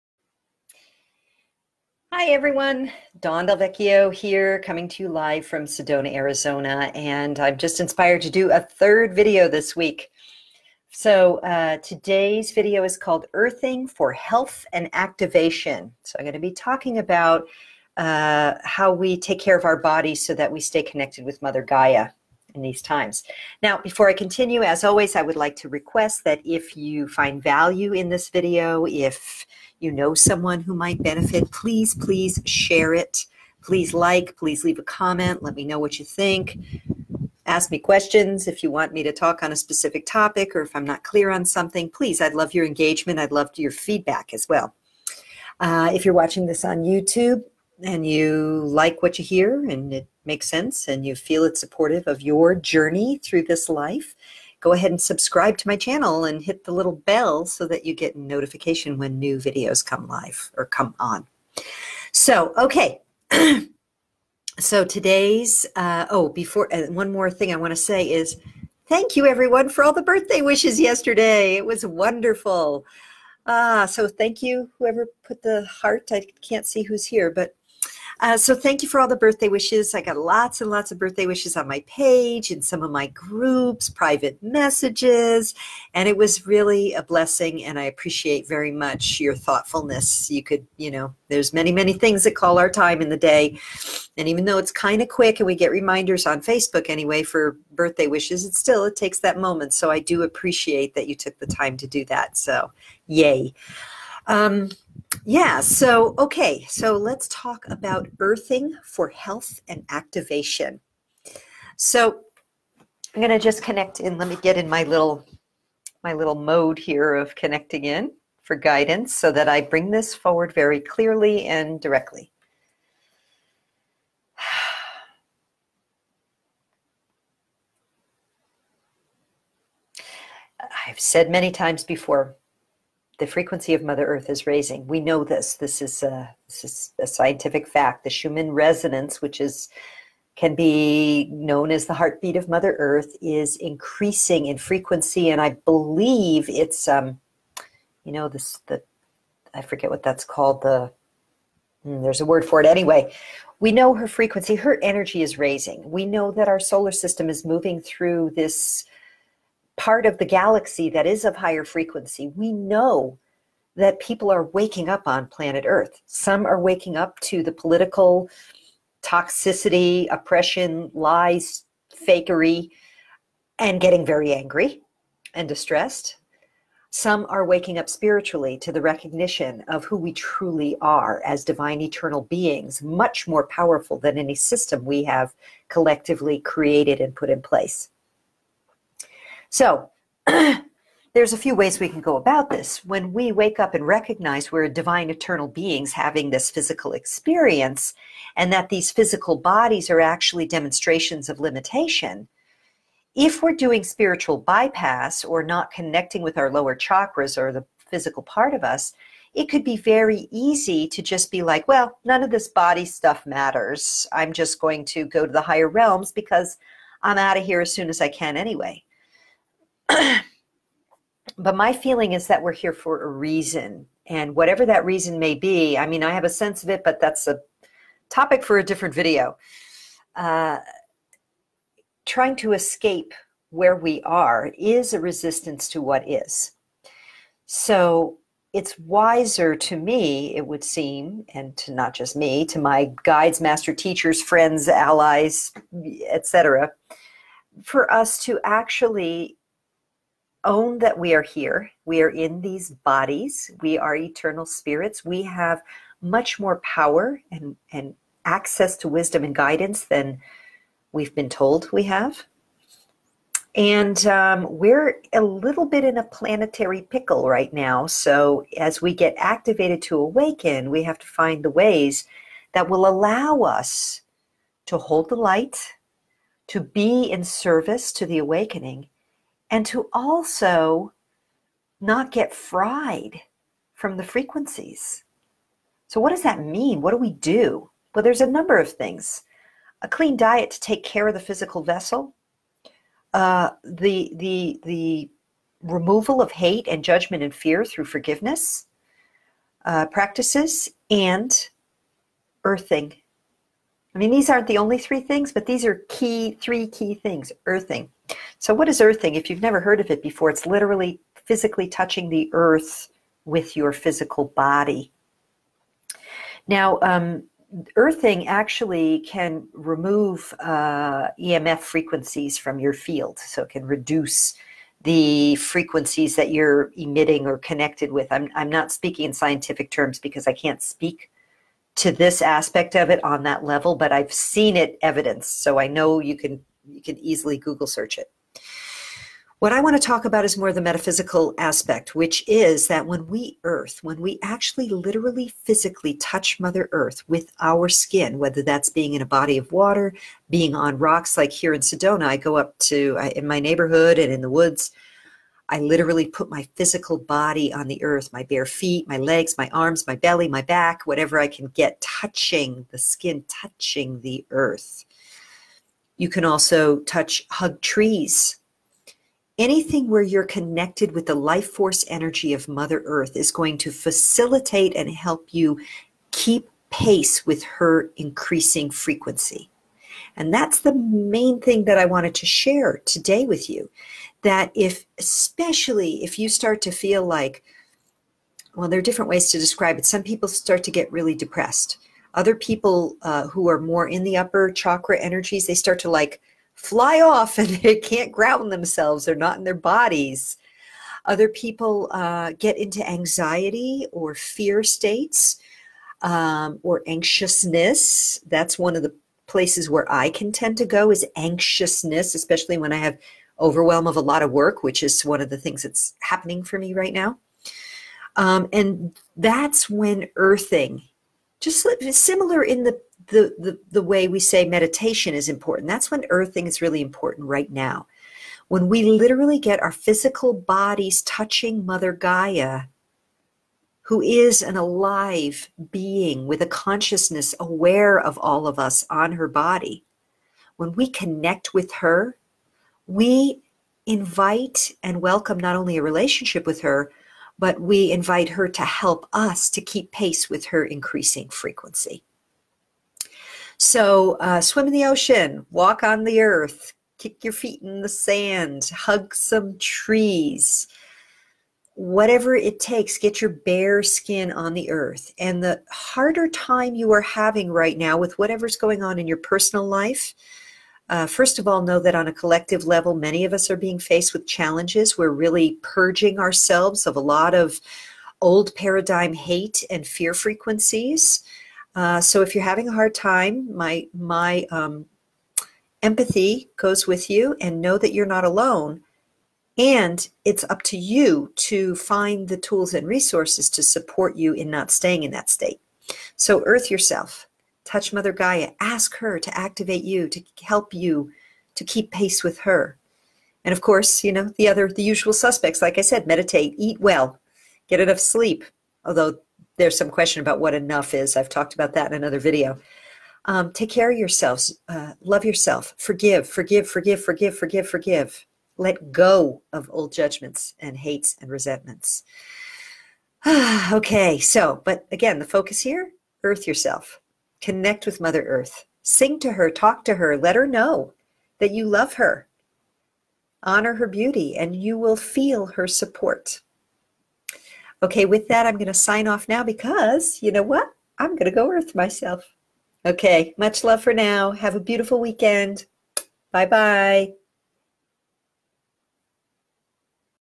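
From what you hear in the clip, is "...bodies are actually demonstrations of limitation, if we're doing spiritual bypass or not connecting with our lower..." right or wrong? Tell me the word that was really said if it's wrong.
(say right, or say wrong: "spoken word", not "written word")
right.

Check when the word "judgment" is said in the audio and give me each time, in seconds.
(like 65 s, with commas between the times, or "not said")
296 s, 519 s.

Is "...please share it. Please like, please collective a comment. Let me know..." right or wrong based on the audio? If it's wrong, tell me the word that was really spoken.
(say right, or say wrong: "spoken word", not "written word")
wrong: "leave", not "collective".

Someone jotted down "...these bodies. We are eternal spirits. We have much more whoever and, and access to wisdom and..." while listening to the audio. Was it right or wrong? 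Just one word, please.
wrong.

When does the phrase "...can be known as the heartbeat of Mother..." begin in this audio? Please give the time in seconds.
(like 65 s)
140 s.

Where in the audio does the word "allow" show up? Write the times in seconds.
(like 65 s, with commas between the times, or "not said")
272 s.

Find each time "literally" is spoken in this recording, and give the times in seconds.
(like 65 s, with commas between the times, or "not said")
310 s, 344 s, 355 s, 428 s.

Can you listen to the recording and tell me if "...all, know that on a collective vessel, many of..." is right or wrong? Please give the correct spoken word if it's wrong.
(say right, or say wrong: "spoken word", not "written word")
wrong: "level", not "vessel".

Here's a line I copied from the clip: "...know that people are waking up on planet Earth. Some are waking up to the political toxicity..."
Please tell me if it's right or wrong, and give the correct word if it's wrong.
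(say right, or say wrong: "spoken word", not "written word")
right.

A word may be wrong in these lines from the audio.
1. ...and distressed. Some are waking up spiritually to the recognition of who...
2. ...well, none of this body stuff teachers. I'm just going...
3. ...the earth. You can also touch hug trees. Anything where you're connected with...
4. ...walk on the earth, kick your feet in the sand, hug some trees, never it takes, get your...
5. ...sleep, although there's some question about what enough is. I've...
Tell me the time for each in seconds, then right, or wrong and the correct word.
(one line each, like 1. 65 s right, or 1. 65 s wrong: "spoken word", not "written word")
1. 175 s right
2. 211 s wrong: "matters", not "teachers"
3. 364 s right
4. 455 s wrong: "whatever", not "never"
5. 507 s right.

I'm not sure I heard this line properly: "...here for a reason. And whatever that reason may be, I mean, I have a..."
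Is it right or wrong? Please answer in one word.
right.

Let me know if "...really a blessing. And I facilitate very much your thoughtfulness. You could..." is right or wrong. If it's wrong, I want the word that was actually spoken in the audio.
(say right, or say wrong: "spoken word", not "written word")
wrong: "appreciate", not "facilitate".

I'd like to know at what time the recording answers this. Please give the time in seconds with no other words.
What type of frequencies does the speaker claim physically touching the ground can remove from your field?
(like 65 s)
321 s.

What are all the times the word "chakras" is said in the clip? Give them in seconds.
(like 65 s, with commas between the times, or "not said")
206 s, 394 s.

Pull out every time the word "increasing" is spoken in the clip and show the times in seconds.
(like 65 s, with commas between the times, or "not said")
143 s, 377 s, 450 s.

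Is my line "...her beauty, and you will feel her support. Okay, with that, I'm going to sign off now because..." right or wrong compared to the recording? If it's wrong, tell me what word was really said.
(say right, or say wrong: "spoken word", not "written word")
right.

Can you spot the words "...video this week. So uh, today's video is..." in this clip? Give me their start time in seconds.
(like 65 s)
9 s.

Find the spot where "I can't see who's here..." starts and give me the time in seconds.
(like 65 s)
76 s.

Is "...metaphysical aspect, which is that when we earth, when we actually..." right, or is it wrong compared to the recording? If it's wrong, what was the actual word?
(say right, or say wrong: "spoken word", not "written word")
right.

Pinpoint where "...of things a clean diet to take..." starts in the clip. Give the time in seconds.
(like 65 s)
288 s.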